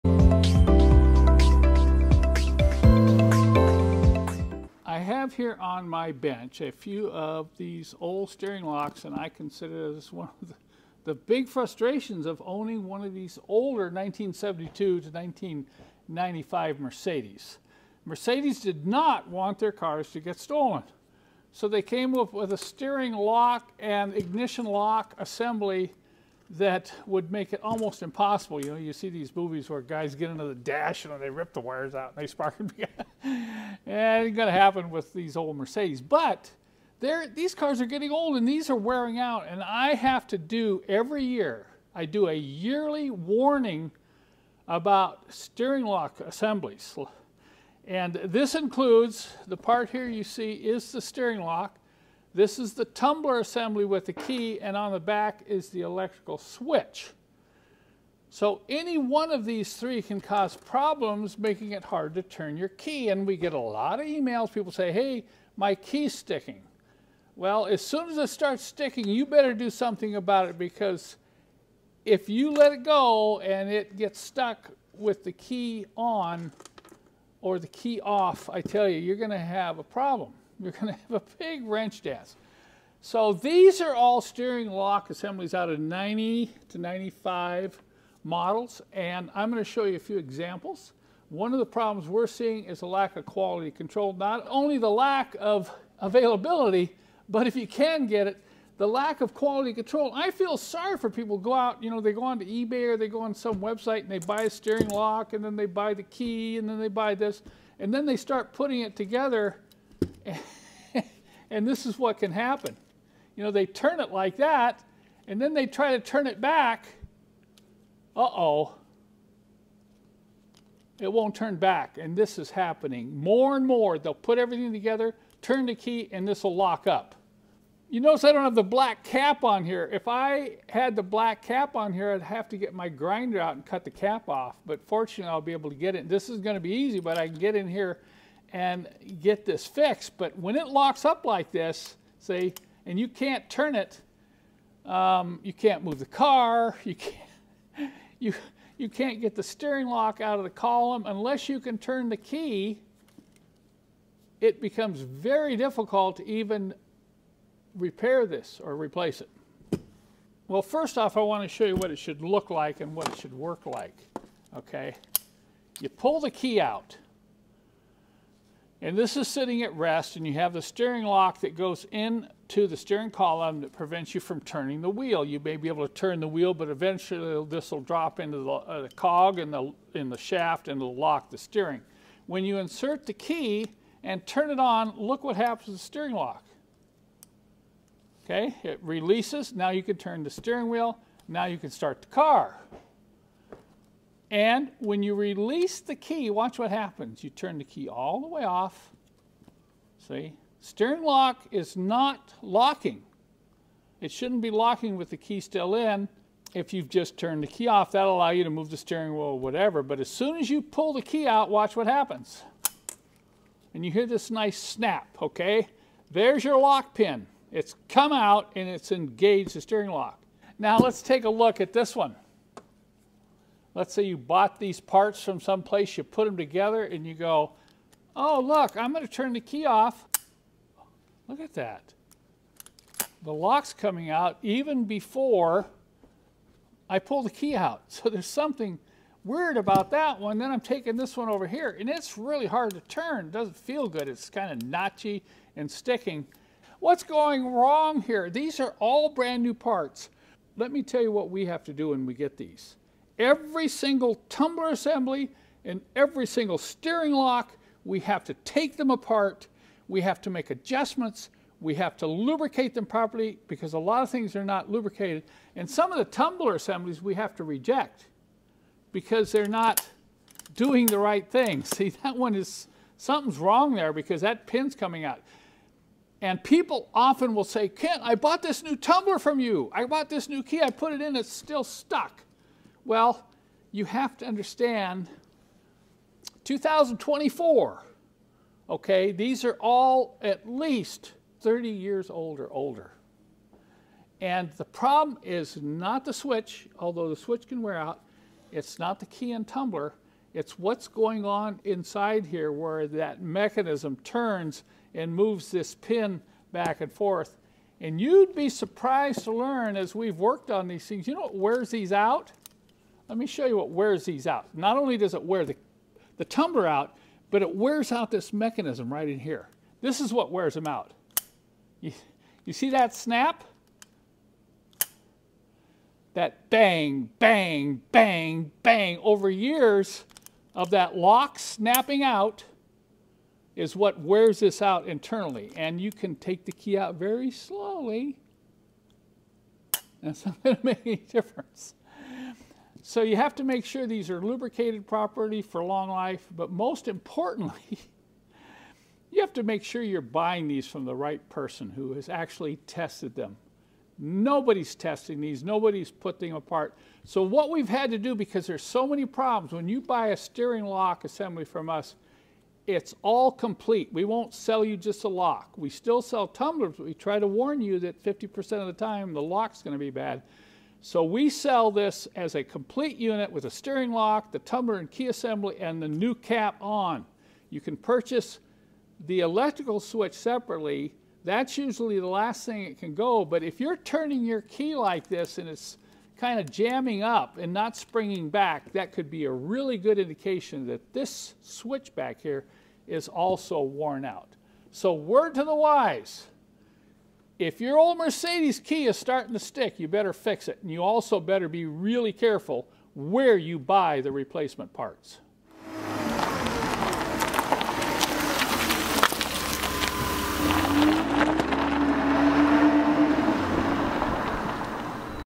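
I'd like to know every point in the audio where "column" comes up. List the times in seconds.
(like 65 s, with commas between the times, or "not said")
150 s, 173 s.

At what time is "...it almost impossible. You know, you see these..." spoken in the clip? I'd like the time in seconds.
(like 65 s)
27 s.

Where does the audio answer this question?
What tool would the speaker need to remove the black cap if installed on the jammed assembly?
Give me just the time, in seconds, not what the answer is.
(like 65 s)
132 s.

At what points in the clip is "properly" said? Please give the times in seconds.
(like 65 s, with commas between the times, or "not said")
262 s, 344 s.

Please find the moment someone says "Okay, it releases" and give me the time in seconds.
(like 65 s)
188 s.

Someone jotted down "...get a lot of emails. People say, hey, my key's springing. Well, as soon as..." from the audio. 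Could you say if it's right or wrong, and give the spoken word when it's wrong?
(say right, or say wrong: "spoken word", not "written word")
wrong: "sticking", not "springing".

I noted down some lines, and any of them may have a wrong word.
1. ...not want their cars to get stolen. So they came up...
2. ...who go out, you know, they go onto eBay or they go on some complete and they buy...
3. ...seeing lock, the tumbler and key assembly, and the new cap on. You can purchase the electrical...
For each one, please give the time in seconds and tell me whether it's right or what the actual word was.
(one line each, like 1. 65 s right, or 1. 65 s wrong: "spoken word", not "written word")
1. 18 s right
2. 101 s wrong: "website", not "complete"
3. 373 s wrong: "steering", not "seeing".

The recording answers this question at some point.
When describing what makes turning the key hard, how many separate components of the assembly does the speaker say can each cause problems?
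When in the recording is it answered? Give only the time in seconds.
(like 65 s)
59 s.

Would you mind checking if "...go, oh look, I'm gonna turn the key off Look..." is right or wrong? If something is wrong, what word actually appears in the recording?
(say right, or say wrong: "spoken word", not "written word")
right.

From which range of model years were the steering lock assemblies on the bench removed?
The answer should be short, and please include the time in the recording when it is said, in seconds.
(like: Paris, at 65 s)
90 to 95, at 85 s.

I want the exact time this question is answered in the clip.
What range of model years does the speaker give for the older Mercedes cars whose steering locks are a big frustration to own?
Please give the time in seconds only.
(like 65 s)
13 s.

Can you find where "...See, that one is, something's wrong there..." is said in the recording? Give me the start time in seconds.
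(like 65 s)
271 s.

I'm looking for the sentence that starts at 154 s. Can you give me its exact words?
It becomes very difficult to even repair this or replace it.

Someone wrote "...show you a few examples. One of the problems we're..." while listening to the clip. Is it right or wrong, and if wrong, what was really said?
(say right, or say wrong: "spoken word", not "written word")
right.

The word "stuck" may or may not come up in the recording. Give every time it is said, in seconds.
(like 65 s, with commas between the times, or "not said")
74 s, 281 s.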